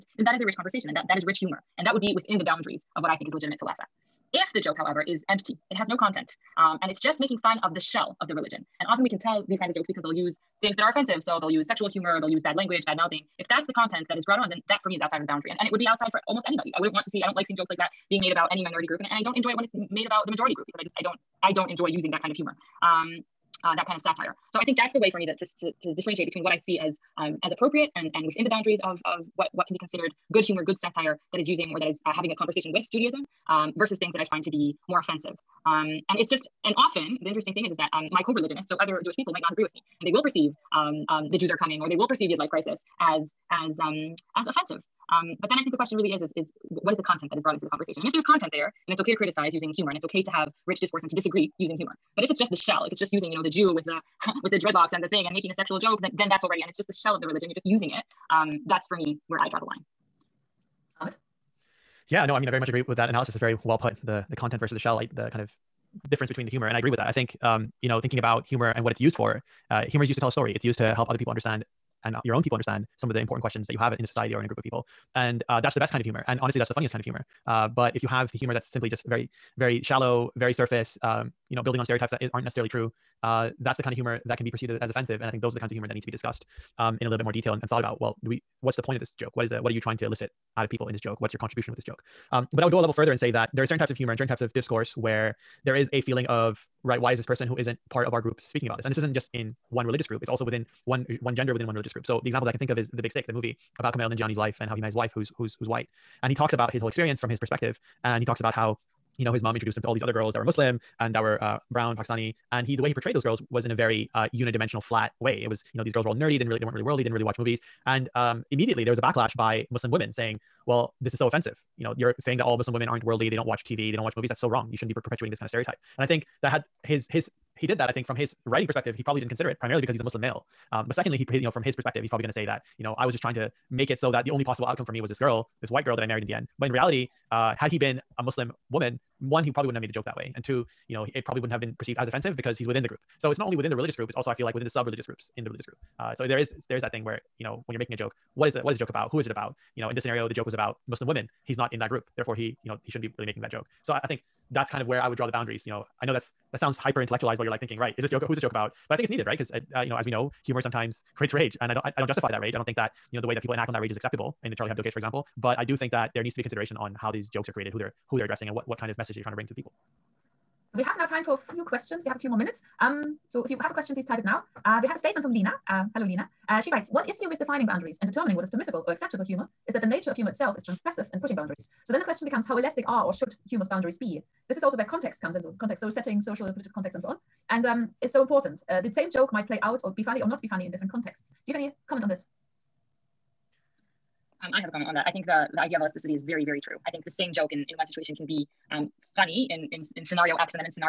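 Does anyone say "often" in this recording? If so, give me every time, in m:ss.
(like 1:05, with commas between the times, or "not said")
0:08, 0:36.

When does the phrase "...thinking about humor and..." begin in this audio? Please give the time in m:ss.
1:08.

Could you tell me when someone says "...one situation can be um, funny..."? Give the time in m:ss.
3:17.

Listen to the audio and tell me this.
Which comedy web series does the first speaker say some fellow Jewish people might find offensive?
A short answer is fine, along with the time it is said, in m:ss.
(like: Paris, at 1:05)
YidLife Crisis, at 0:42.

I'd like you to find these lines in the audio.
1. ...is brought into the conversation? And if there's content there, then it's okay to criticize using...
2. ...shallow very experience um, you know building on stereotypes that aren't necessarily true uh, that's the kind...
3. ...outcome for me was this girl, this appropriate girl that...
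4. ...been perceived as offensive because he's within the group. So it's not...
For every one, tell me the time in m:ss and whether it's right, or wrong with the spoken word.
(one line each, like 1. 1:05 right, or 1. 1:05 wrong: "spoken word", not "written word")
1. 0:47 right
2. 1:19 wrong: "surface", not "experience"
3. 2:14 wrong: "white", not "appropriate"
4. 2:21 right.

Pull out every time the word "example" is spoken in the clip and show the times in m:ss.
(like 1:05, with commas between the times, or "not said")
1:42, 2:44.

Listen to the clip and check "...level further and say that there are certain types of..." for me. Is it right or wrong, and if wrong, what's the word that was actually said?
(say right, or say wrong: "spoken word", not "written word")
right.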